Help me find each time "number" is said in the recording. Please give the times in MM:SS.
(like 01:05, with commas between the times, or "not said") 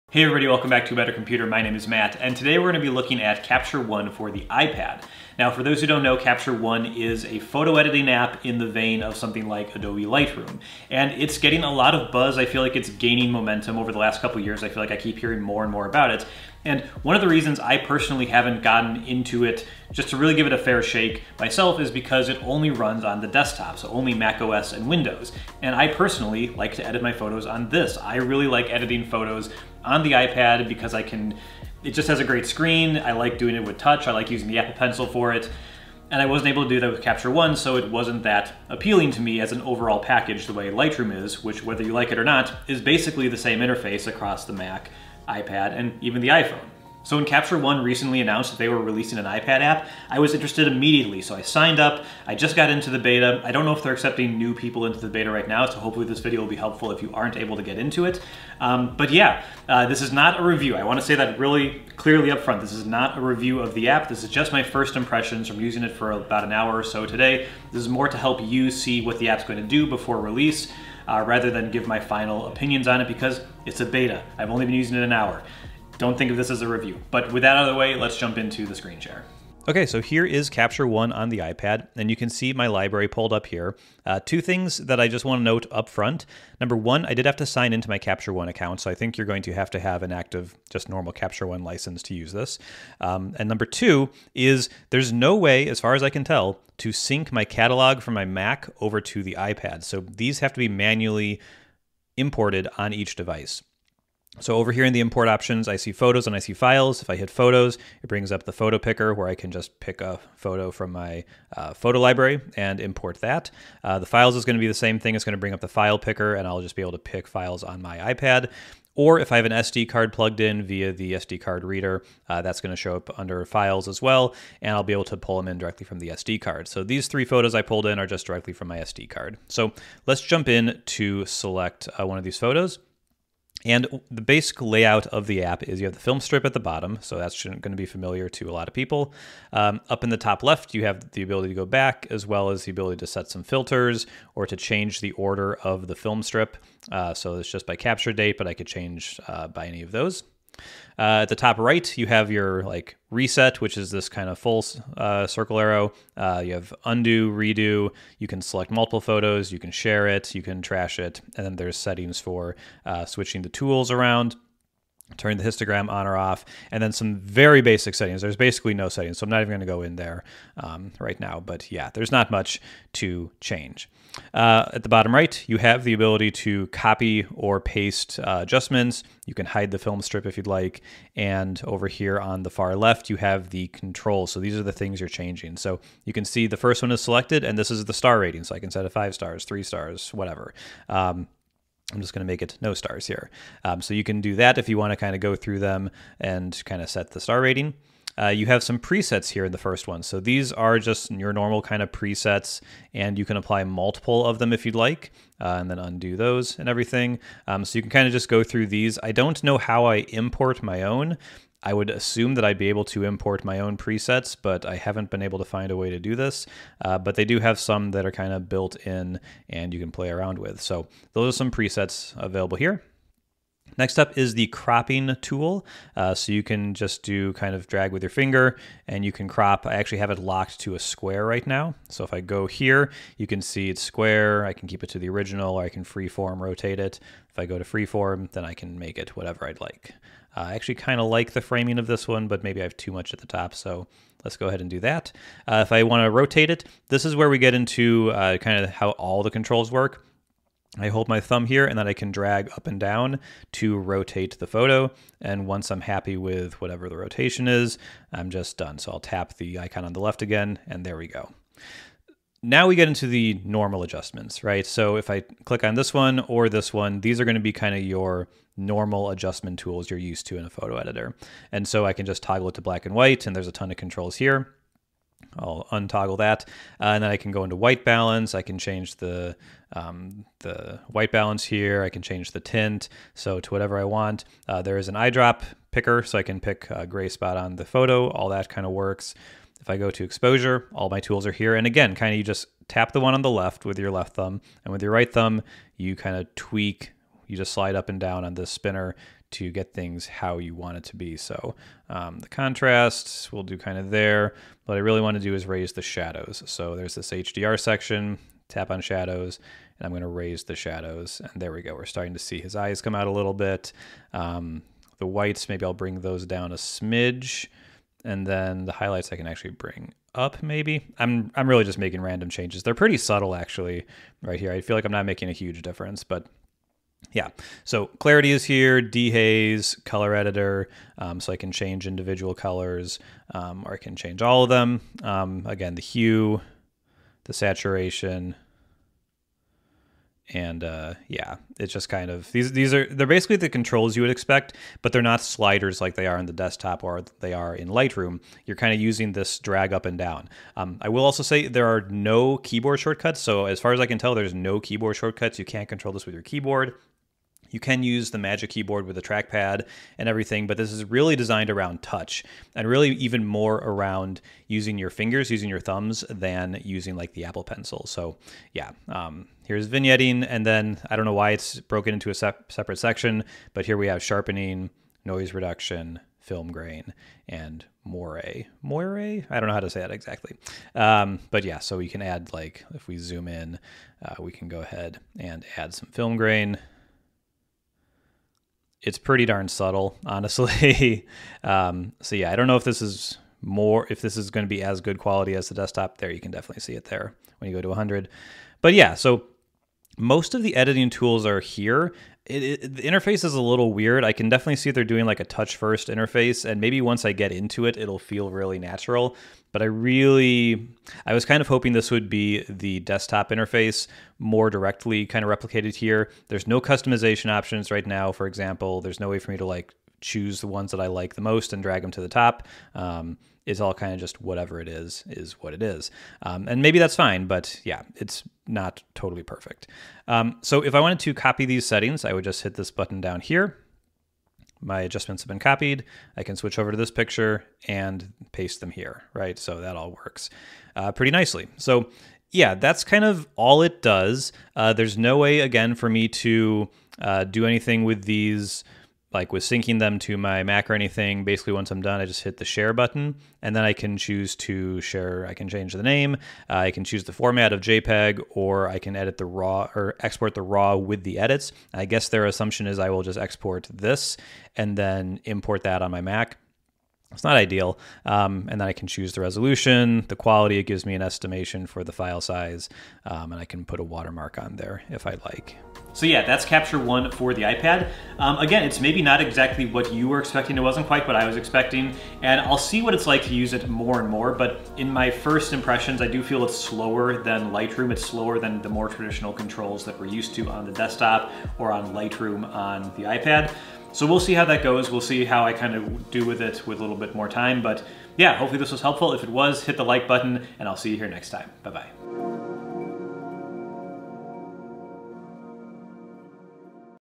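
01:26, 01:33.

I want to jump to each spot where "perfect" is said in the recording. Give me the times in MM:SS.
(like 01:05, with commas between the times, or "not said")
07:09.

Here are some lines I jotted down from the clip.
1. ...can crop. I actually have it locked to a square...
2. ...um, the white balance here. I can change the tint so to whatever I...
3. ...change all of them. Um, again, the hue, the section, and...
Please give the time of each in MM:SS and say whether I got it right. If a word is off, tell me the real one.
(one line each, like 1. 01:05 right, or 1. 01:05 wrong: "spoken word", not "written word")
1. 03:49 right
2. 04:39 right
3. 05:33 wrong: "saturation", not "section".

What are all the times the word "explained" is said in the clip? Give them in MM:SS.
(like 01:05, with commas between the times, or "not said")
not said.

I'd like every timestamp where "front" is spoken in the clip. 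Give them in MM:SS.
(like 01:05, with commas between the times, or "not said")
01:02, 01:25.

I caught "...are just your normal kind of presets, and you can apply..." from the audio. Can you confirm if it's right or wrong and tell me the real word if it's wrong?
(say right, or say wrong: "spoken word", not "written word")
right.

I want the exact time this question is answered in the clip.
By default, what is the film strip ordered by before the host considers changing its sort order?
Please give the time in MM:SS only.
02:27.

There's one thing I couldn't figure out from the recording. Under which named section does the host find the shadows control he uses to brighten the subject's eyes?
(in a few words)
HDR.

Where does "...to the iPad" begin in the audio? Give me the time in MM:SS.
01:39.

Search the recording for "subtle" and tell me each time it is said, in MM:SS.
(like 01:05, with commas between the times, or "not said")
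05:22, 06:29.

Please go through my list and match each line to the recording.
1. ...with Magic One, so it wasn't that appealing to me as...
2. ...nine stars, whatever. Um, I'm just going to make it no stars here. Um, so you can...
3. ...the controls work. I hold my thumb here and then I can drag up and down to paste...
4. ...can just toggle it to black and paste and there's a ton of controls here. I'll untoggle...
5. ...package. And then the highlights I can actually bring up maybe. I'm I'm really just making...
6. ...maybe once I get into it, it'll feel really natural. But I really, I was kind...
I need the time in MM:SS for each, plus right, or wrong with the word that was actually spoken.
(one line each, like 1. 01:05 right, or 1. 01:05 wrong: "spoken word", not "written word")
1. 00:36 wrong: "Capture", not "Magic"
2. 03:09 wrong: "three", not "nine"
3. 04:09 wrong: "rotate", not "paste"
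4. 04:31 wrong: "white", not "paste"
5. 05:16 wrong: "smidge", not "package"
6. 06:46 right.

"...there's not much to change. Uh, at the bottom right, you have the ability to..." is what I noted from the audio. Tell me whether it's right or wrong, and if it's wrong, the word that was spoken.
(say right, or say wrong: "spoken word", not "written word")
right.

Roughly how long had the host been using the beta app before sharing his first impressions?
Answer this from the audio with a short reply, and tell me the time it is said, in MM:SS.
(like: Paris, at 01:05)
about an hour, at 01:06.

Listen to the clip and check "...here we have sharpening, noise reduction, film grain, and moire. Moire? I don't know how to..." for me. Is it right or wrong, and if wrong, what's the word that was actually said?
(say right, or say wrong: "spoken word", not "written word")
right.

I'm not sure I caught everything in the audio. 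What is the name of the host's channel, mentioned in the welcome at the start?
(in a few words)
A Better Computer.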